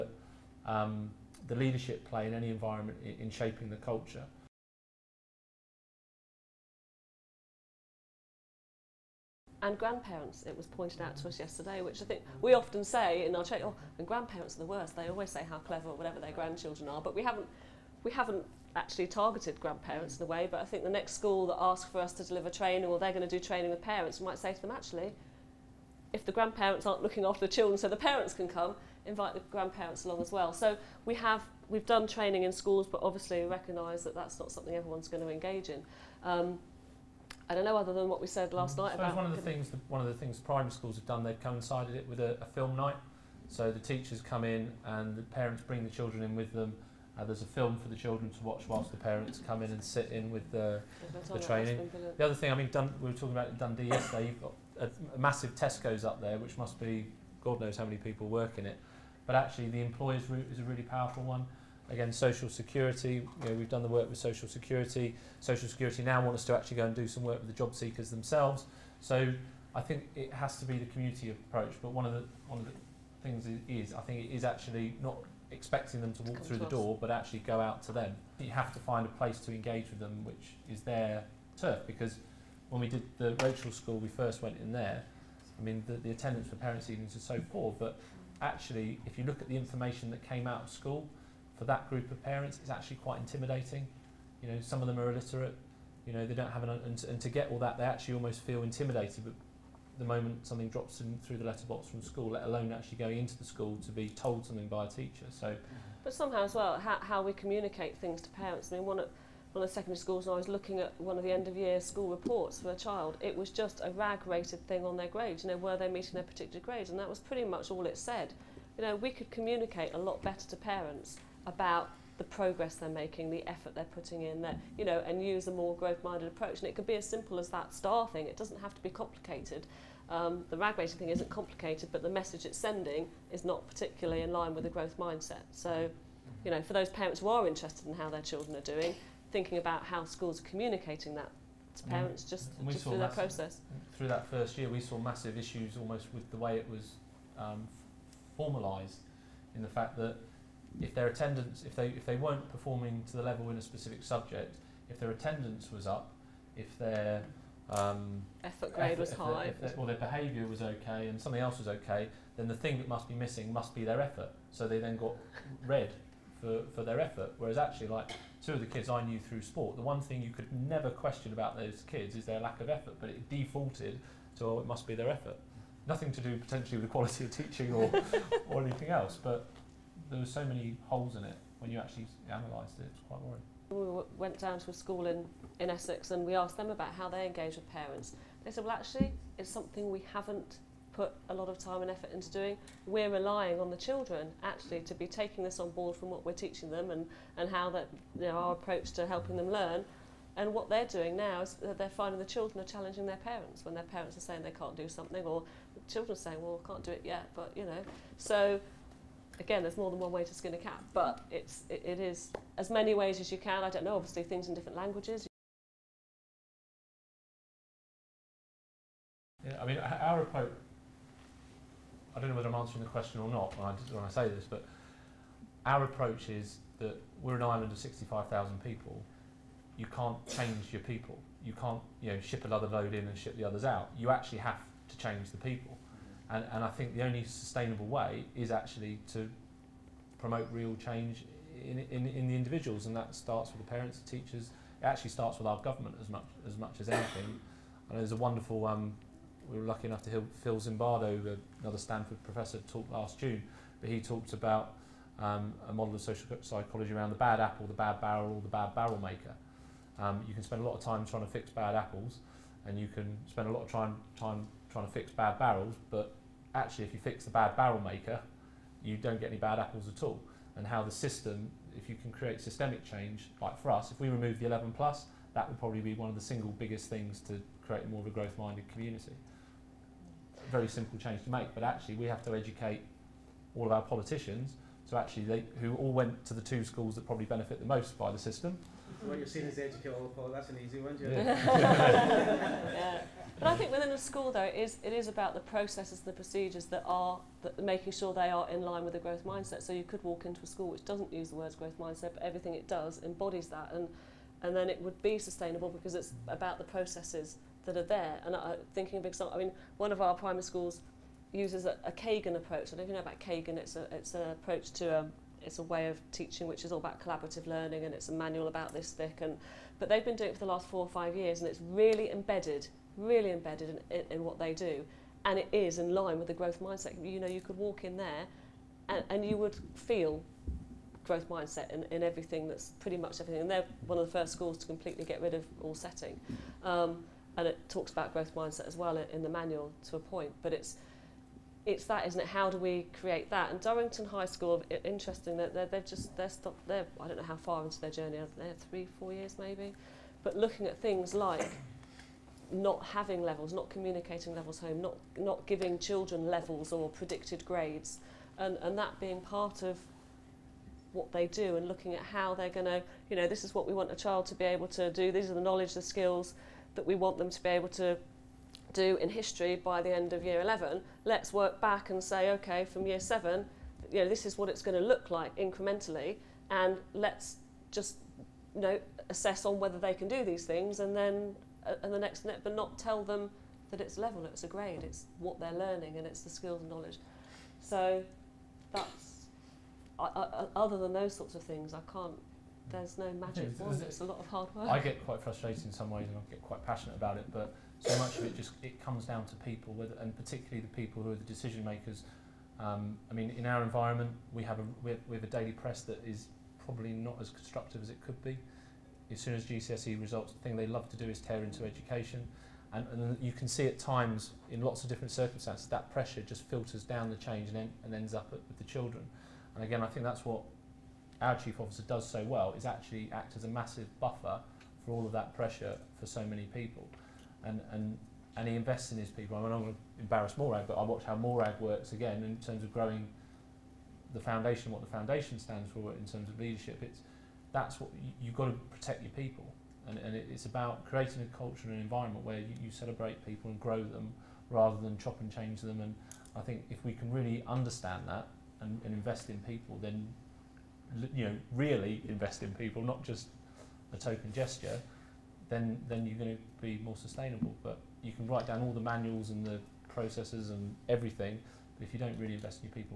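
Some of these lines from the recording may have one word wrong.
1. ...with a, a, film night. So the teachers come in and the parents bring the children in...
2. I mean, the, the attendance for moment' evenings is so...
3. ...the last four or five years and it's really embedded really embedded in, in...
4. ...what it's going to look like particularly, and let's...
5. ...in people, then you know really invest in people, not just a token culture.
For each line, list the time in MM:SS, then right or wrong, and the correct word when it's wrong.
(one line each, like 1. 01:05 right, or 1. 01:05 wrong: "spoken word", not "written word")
1. 00:42 right
2. 01:25 wrong: "parents", not "moment"
3. 05:20 right
4. 06:14 wrong: "incrementally", not "particularly"
5. 07:29 wrong: "gesture", not "culture".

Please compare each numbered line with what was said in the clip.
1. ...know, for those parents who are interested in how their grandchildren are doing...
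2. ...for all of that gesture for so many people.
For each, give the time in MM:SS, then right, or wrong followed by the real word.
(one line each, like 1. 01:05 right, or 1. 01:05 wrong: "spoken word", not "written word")
1. 02:16 wrong: "children", not "grandchildren"
2. 07:04 wrong: "pressure", not "gesture".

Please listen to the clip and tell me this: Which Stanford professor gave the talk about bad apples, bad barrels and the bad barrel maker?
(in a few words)
Phil Zimbardo.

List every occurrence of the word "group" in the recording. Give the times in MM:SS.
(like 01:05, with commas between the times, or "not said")
01:31.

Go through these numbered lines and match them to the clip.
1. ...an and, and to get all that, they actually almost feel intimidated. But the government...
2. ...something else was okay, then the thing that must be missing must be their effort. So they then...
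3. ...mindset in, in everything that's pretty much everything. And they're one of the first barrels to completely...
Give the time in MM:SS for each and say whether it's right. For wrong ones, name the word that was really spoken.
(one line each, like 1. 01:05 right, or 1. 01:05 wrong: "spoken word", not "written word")
1. 01:36 wrong: "moment", not "government"
2. 02:41 right
3. 05:31 wrong: "schools", not "barrels".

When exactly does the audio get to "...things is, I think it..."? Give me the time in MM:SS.
01:13.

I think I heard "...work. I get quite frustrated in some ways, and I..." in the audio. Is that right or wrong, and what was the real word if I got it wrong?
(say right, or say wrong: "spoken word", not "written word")
right.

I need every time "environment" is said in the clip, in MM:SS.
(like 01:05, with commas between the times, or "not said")
00:02, 06:43, 07:21.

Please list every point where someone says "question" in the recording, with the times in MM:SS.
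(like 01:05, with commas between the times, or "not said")
02:50, 03:42.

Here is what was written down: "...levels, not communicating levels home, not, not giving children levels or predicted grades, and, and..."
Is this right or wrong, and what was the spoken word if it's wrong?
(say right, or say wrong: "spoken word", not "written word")
right.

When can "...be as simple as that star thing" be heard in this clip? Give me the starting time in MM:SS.
02:06.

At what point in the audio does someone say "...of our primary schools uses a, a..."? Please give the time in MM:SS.
05:09.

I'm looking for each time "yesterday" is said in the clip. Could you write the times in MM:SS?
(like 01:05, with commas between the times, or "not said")
00:11, 00:53.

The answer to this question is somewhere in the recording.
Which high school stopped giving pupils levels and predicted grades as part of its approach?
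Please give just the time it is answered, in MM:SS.
05:43.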